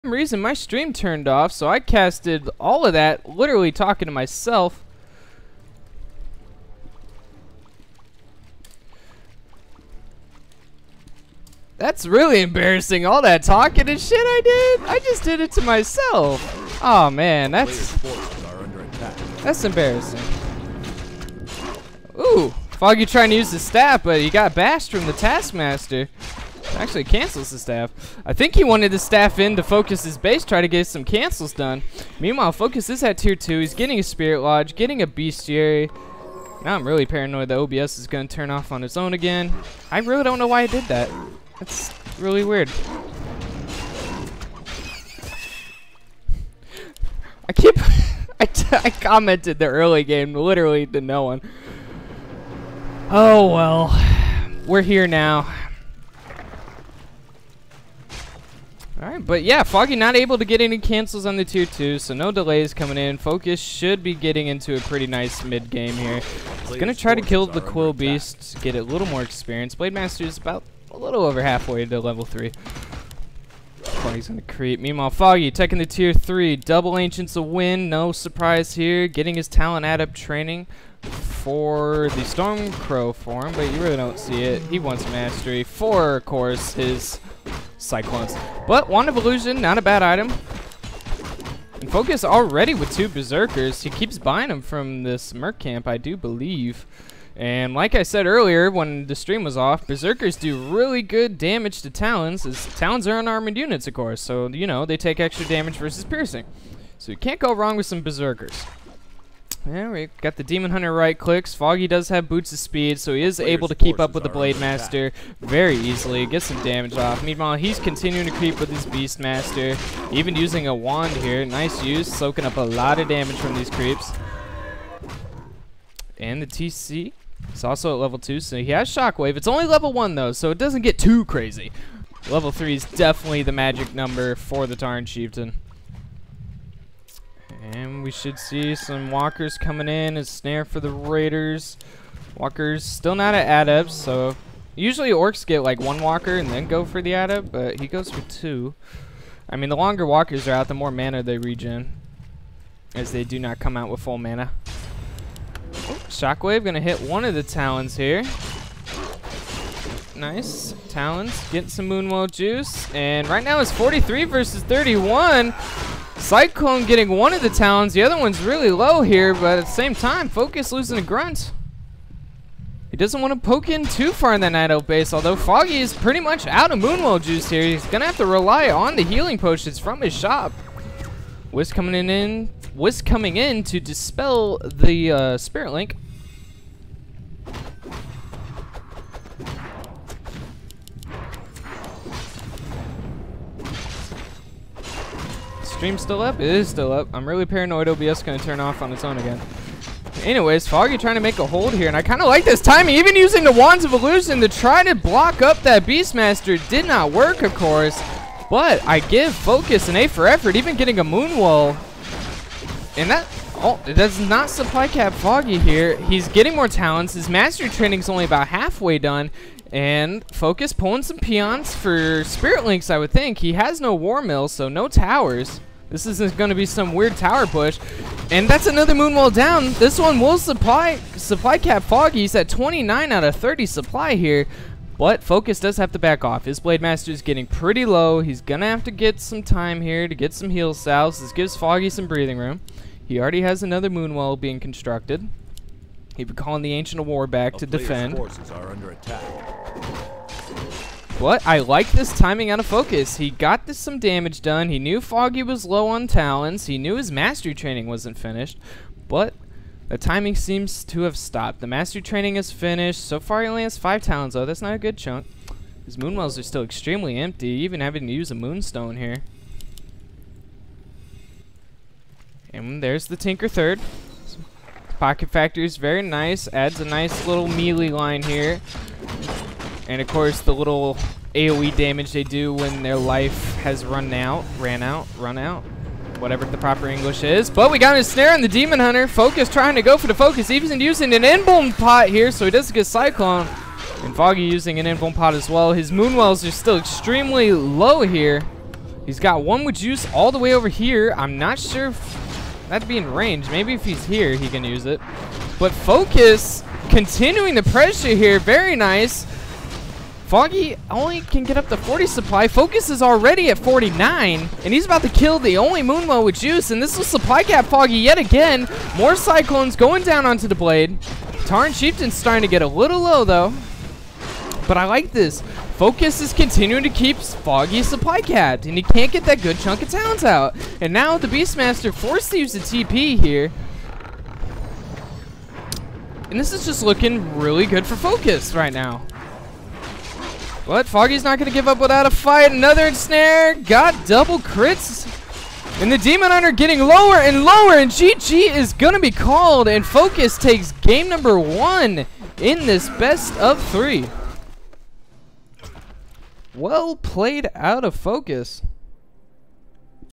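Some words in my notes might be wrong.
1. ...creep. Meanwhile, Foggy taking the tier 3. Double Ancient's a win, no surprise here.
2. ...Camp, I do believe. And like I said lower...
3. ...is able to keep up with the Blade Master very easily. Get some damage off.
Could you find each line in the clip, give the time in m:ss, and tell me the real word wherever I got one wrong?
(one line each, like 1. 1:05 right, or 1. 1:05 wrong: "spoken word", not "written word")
1. 1:14 right
2. 1:35 wrong: "earlier", not "lower"
3. 1:53 right.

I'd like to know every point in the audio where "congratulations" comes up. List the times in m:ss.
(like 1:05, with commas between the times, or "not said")
not said.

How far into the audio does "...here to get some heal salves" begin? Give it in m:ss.
3:59.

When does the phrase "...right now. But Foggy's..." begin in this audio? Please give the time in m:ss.
5:38.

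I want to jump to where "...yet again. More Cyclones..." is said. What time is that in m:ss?
5:17.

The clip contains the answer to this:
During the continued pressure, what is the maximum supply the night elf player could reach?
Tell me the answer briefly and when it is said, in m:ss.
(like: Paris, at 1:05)
40, at 5:11.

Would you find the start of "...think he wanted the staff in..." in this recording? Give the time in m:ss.
0:28.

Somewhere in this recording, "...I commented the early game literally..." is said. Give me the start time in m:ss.
0:48.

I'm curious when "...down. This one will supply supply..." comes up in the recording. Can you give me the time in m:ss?
3:49.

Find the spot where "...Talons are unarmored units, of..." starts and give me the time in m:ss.
1:42.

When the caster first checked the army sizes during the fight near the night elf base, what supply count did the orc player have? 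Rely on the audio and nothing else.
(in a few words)
43.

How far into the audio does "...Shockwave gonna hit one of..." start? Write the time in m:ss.
2:36.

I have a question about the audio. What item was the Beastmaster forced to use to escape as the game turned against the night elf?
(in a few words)
TP.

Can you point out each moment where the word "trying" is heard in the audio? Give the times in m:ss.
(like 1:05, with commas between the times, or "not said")
0:23, 3:20, 4:49.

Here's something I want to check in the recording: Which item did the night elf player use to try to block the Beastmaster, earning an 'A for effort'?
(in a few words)
Wands of Illusion.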